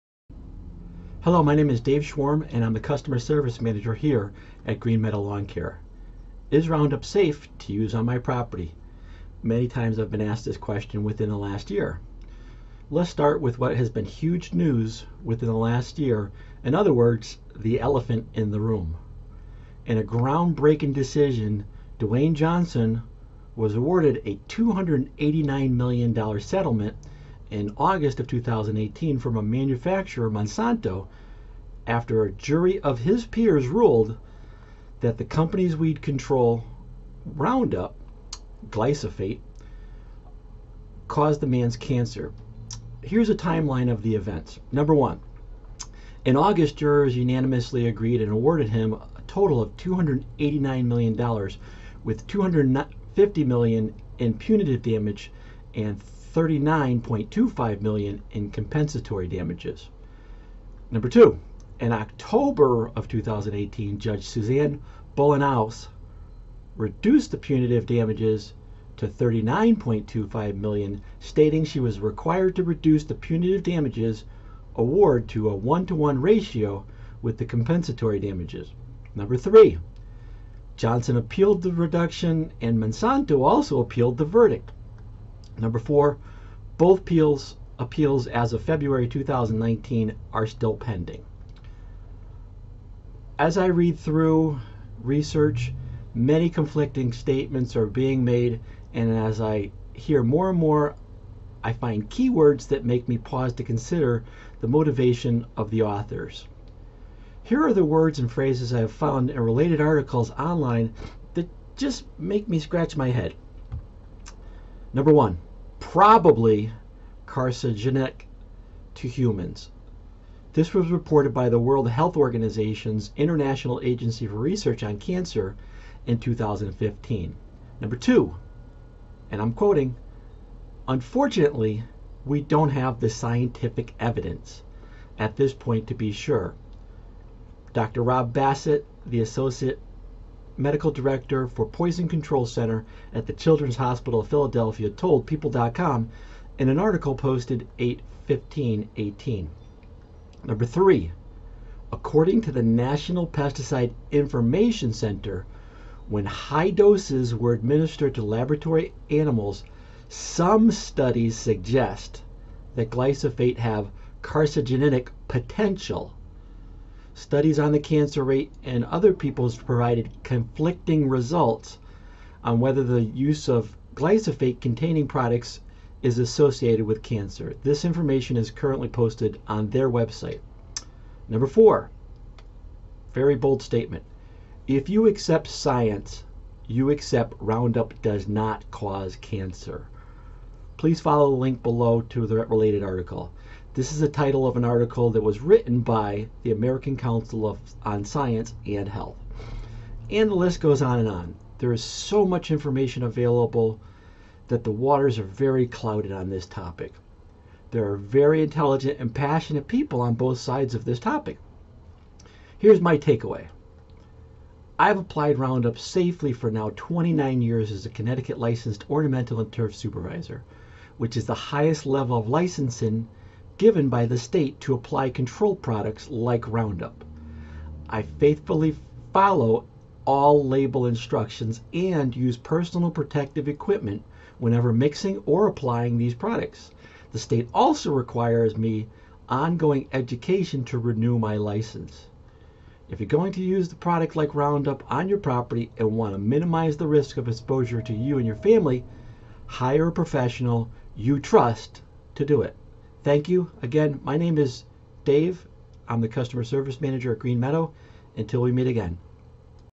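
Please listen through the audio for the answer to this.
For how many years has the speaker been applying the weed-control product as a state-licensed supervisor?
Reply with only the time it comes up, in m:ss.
3:36.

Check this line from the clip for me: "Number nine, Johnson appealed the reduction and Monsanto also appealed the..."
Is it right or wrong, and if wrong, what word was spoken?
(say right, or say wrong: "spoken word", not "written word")
wrong: "three", not "nine".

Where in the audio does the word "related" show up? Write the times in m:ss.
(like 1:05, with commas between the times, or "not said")
1:49, 3:12.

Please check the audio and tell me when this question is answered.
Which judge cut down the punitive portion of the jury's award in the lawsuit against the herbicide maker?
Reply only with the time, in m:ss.
1:04.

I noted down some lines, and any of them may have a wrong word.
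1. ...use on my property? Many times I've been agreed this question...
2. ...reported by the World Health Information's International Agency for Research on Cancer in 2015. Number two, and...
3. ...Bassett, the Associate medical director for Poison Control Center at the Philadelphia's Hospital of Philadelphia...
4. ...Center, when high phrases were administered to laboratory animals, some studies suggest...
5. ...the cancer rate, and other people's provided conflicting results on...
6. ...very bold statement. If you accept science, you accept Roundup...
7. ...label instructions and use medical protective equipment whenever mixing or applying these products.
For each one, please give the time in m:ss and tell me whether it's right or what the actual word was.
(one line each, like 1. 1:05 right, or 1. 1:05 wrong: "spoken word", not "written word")
1. 0:07 wrong: "asked", not "agreed"
2. 2:00 wrong: "Organization", not "Information"
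3. 2:18 wrong: "Children", not "Philadelphia"
4. 2:34 wrong: "doses", not "phrases"
5. 2:47 right
6. 3:03 right
7. 3:50 wrong: "personal", not "medical".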